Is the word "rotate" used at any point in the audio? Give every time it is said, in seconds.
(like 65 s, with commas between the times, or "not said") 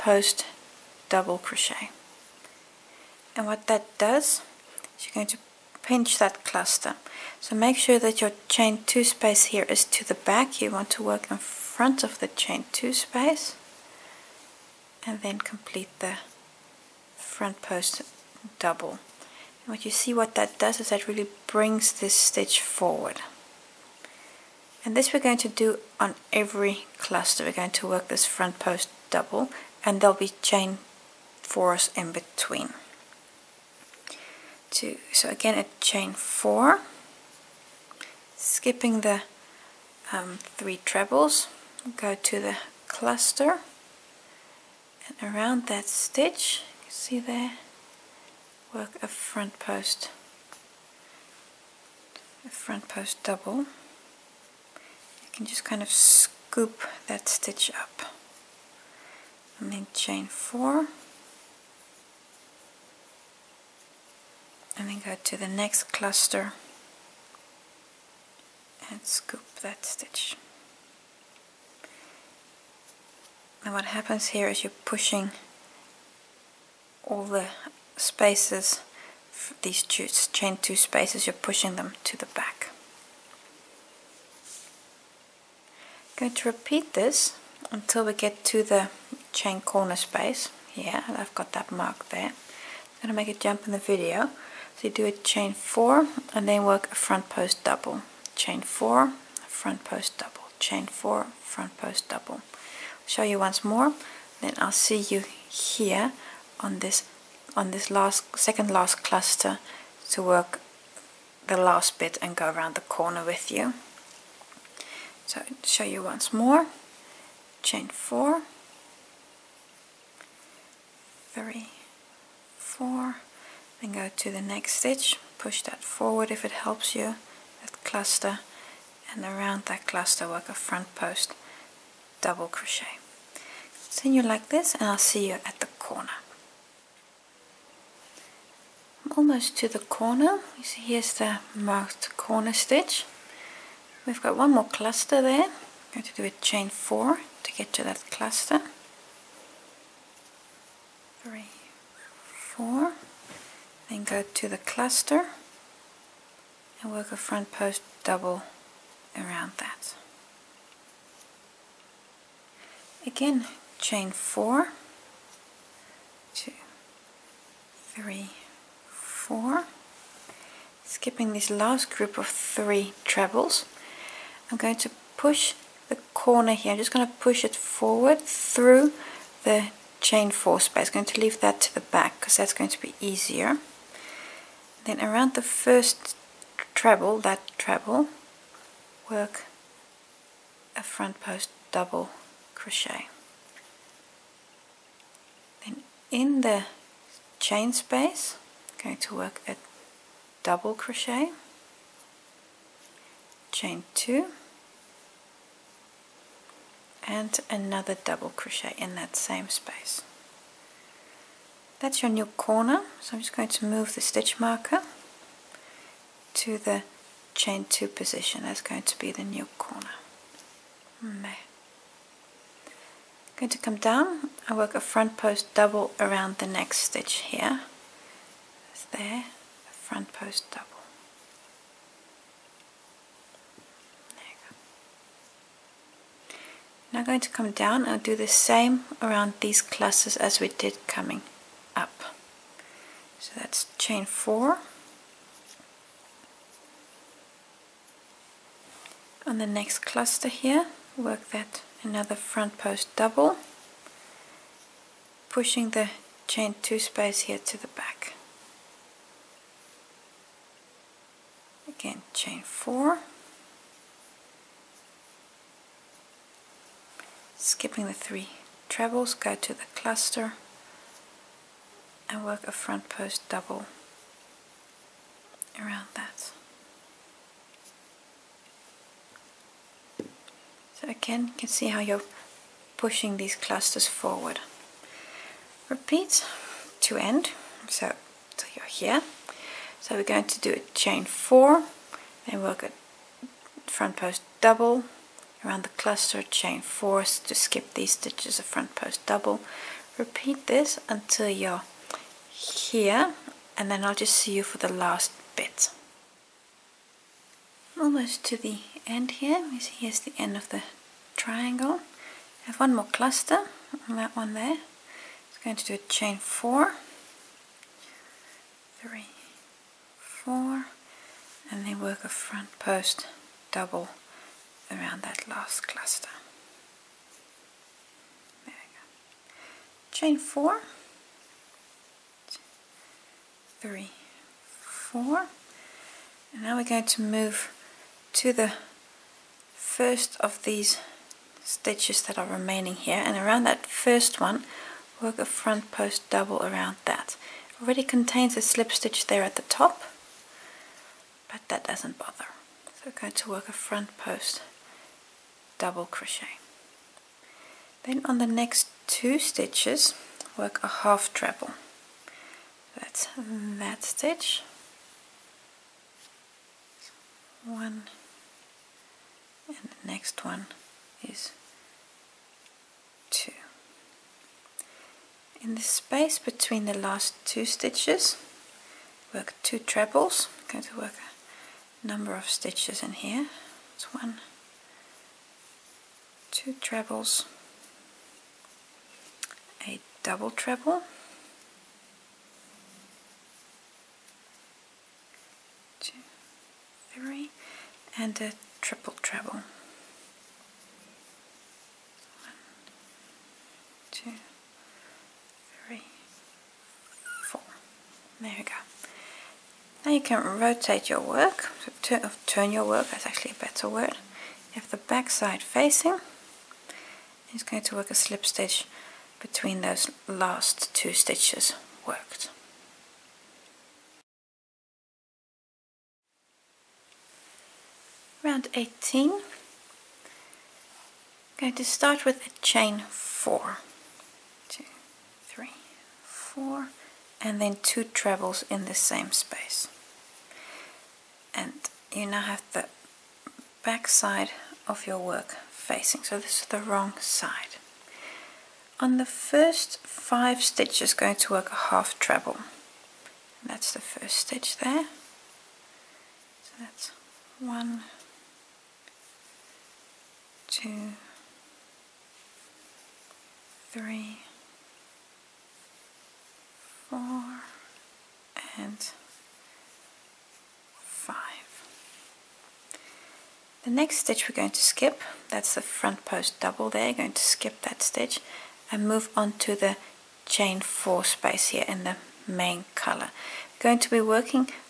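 410 s.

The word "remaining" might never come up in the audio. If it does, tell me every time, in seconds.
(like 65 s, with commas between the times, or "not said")
342 s.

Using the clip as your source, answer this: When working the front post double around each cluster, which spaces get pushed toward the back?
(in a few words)
Chain two spaces.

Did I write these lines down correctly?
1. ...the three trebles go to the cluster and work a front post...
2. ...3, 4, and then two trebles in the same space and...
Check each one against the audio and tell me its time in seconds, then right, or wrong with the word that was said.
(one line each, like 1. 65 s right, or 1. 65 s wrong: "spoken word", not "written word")
1. 267 s right
2. 435 s right.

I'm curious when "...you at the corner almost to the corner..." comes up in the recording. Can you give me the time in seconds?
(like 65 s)
135 s.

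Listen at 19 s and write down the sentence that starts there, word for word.
What you see what that does is that really brings this stitch forward.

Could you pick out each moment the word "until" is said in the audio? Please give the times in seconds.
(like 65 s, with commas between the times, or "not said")
87 s, 300 s.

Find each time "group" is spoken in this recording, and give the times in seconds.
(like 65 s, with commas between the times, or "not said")
171 s.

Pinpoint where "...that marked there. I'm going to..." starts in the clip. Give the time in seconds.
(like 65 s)
91 s.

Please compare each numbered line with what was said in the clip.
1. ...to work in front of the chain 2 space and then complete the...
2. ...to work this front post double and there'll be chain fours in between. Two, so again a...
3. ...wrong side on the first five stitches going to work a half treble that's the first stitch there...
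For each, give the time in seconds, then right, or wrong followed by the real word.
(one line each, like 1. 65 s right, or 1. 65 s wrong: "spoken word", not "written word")
1. 10 s right
2. 27 s right
3. 446 s right.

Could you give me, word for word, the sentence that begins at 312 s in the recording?
I have one more cluster on that one there.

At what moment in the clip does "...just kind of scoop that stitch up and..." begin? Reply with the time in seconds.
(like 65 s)
55 s.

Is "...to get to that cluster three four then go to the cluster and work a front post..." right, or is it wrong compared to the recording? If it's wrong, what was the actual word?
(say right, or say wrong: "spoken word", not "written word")
right.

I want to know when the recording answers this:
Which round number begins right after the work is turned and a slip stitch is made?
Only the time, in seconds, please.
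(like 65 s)
428 s.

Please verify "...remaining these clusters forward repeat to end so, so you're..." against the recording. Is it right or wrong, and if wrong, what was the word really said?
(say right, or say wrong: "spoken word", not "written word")
wrong: "pushing", not "remaining".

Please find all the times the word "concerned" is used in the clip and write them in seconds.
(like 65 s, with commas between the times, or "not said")
not said.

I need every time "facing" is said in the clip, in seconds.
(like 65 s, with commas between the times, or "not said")
415 s, 445 s.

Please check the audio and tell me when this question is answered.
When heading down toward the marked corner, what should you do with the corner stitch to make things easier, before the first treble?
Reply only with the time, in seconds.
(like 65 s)
177 s.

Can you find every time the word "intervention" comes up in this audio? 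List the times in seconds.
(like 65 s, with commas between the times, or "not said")
not said.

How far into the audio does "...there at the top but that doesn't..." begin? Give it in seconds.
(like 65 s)
349 s.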